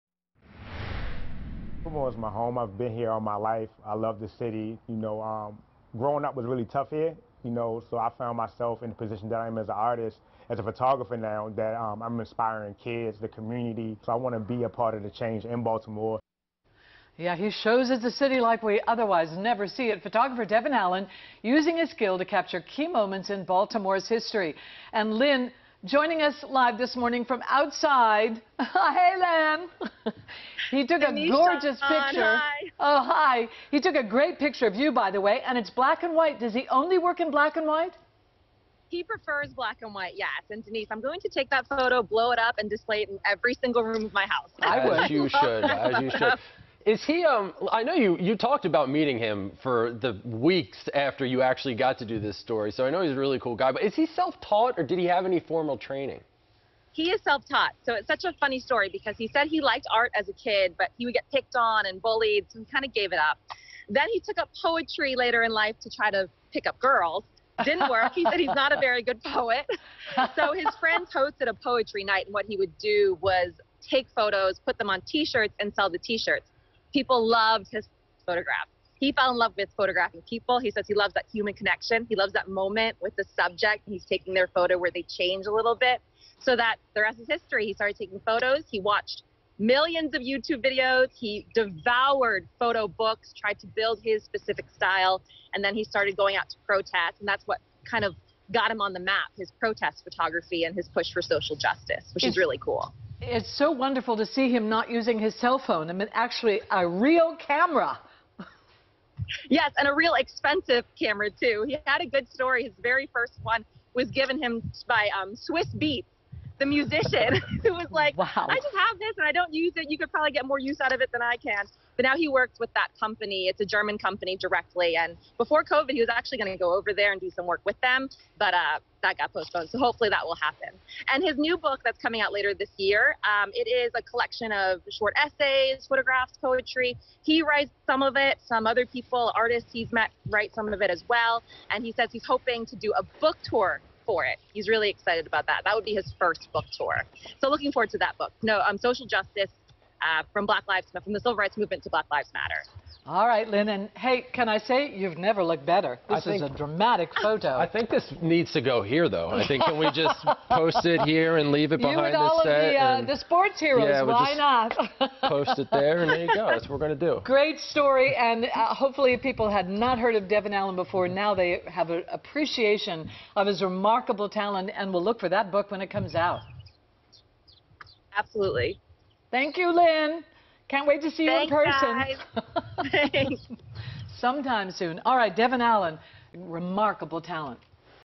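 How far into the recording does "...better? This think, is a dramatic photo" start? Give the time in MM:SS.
02:35.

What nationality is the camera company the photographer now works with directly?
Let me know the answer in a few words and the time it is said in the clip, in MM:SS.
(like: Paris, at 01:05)
German, at 02:03.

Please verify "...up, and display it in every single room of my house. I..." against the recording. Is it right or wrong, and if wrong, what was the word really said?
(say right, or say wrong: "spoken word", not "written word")
right.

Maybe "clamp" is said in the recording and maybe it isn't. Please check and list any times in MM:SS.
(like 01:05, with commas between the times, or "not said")
not said.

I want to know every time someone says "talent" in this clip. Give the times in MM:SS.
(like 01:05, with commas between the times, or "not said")
02:54, 03:07.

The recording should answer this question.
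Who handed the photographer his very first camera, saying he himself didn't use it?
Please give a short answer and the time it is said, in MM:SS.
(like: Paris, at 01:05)
Swizz Beatz, at 01:55.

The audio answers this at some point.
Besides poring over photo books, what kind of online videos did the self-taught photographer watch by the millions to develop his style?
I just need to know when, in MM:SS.
01:30.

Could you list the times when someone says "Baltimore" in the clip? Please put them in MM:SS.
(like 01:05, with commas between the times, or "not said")
00:01, 00:15, 00:23.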